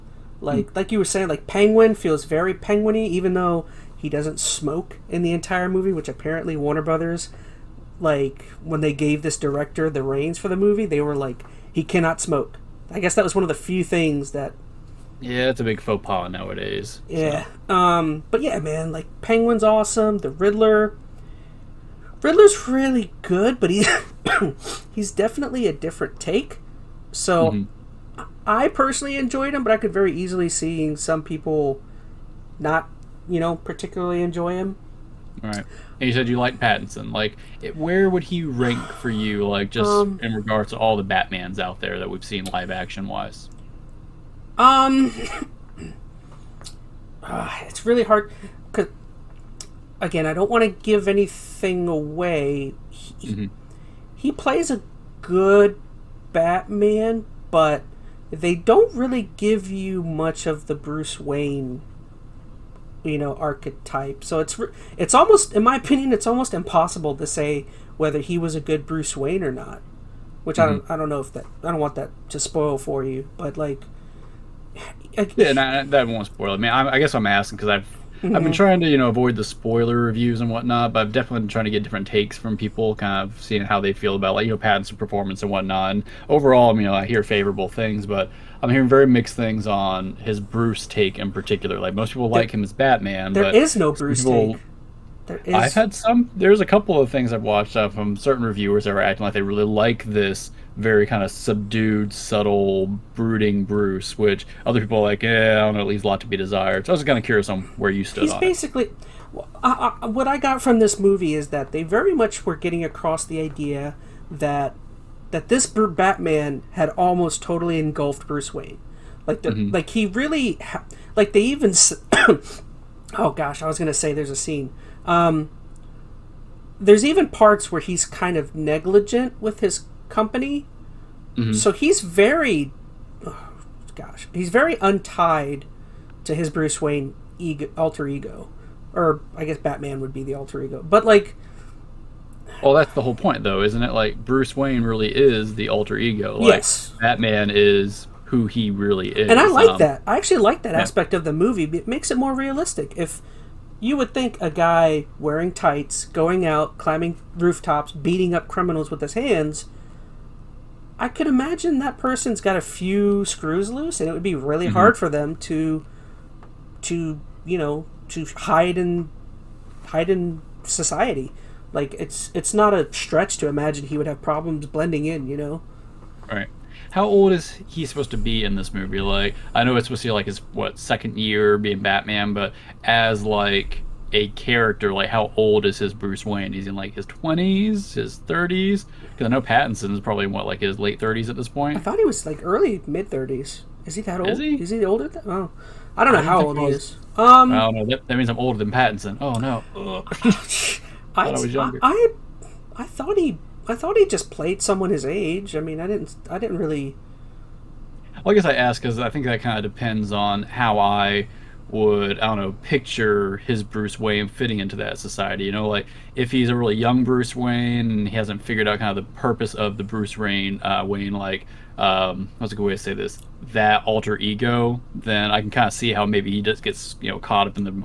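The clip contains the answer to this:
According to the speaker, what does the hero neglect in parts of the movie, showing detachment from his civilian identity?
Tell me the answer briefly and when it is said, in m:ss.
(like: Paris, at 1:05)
His company, at 2:09.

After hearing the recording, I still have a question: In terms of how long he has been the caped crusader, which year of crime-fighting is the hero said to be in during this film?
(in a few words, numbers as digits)
Second year.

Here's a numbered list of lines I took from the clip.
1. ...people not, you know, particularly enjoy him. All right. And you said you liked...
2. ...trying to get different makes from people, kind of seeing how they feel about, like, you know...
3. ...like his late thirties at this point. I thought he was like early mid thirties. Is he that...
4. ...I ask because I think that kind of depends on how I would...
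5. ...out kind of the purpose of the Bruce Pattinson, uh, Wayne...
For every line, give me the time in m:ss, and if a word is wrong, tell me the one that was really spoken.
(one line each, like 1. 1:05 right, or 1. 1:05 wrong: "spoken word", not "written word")
1. 0:31 right
2. 1:21 wrong: "takes", not "makes"
3. 3:10 right
4. 3:28 right
5. 3:38 wrong: "Wayne", not "Pattinson".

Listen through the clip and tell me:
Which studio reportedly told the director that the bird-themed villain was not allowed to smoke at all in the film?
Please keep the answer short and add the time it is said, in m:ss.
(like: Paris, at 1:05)
Warner Brothers, at 0:06.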